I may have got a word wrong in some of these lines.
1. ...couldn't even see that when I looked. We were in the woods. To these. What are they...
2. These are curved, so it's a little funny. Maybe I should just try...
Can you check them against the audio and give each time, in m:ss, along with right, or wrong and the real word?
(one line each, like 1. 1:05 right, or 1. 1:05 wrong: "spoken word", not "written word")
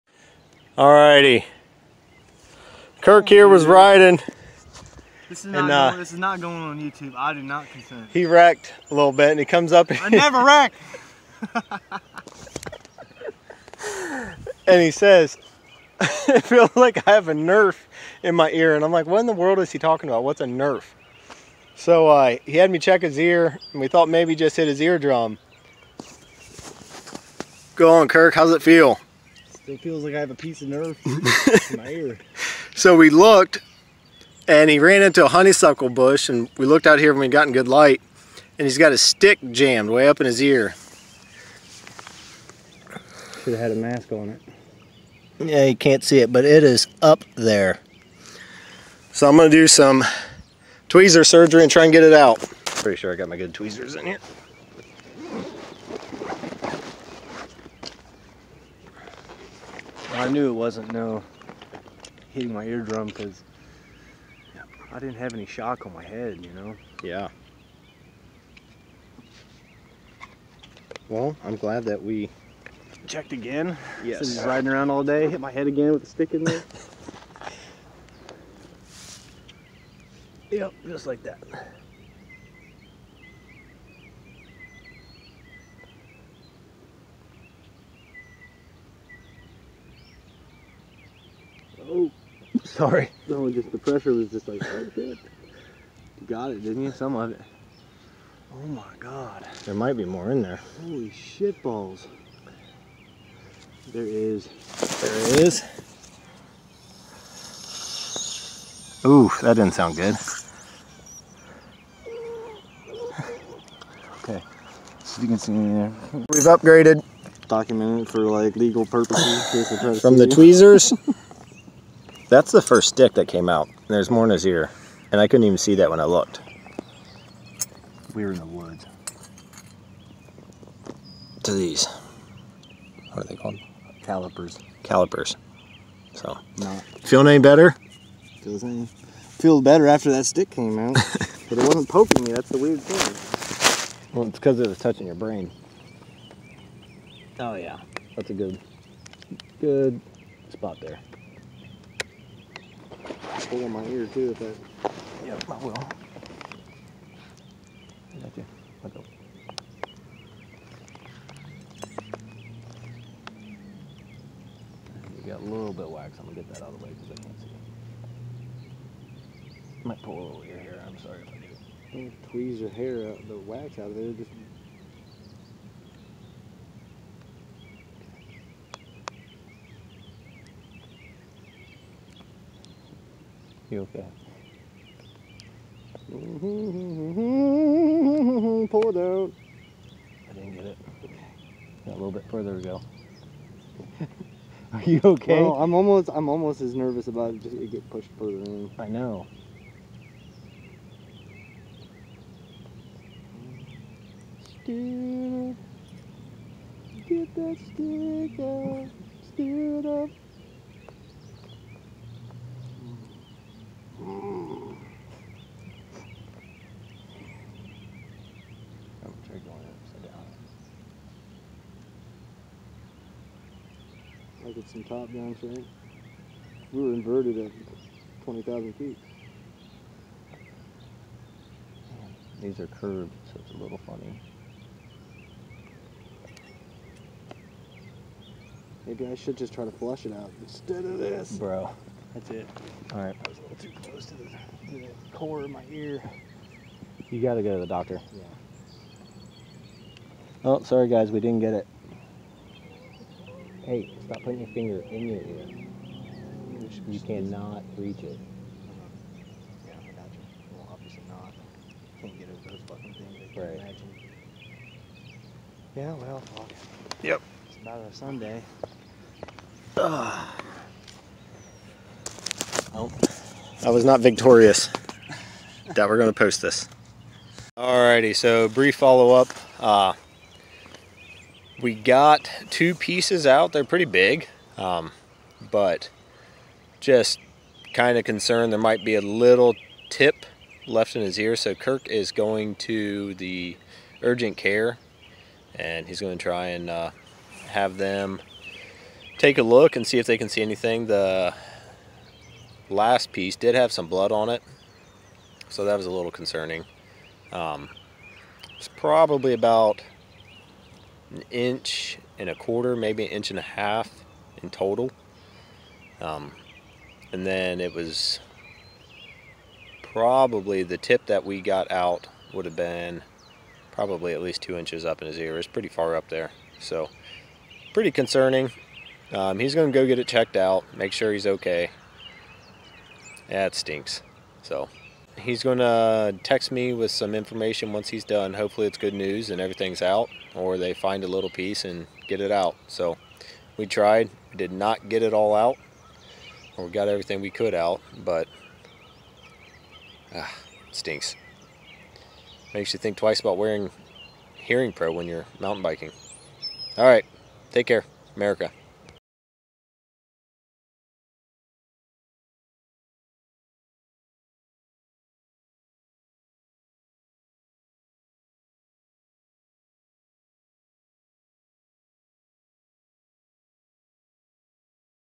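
1. 2:05 right
2. 3:52 right.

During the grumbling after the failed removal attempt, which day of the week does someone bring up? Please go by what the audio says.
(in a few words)
Sunday.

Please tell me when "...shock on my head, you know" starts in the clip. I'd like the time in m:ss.
1:05.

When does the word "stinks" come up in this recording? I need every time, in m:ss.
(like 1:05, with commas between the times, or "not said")
5:33, 5:50.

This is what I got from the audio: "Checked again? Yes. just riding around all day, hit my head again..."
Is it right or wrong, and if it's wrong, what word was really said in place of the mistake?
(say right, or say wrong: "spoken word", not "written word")
right.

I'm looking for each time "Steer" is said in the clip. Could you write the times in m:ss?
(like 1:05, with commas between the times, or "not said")
3:24, 3:29.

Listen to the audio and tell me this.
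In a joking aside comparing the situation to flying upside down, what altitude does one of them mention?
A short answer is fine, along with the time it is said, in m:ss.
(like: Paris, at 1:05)
20,000 feet, at 3:48.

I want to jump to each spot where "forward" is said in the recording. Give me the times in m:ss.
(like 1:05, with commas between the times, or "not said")
not said.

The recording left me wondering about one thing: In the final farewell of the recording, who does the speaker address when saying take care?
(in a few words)
America.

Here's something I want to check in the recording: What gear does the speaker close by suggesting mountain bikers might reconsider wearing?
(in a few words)
hearing pro.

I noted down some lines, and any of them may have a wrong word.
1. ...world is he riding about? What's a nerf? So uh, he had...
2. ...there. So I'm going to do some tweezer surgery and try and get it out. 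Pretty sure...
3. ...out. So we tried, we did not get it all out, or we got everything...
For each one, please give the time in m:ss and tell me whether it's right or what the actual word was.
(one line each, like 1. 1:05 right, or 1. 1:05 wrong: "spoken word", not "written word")
1. 0:19 wrong: "talking", not "riding"
2. 0:47 right
3. 5:42 right.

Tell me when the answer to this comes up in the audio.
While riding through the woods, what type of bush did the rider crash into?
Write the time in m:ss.
0:35.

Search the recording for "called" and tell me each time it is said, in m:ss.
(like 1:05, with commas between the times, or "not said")
2:13.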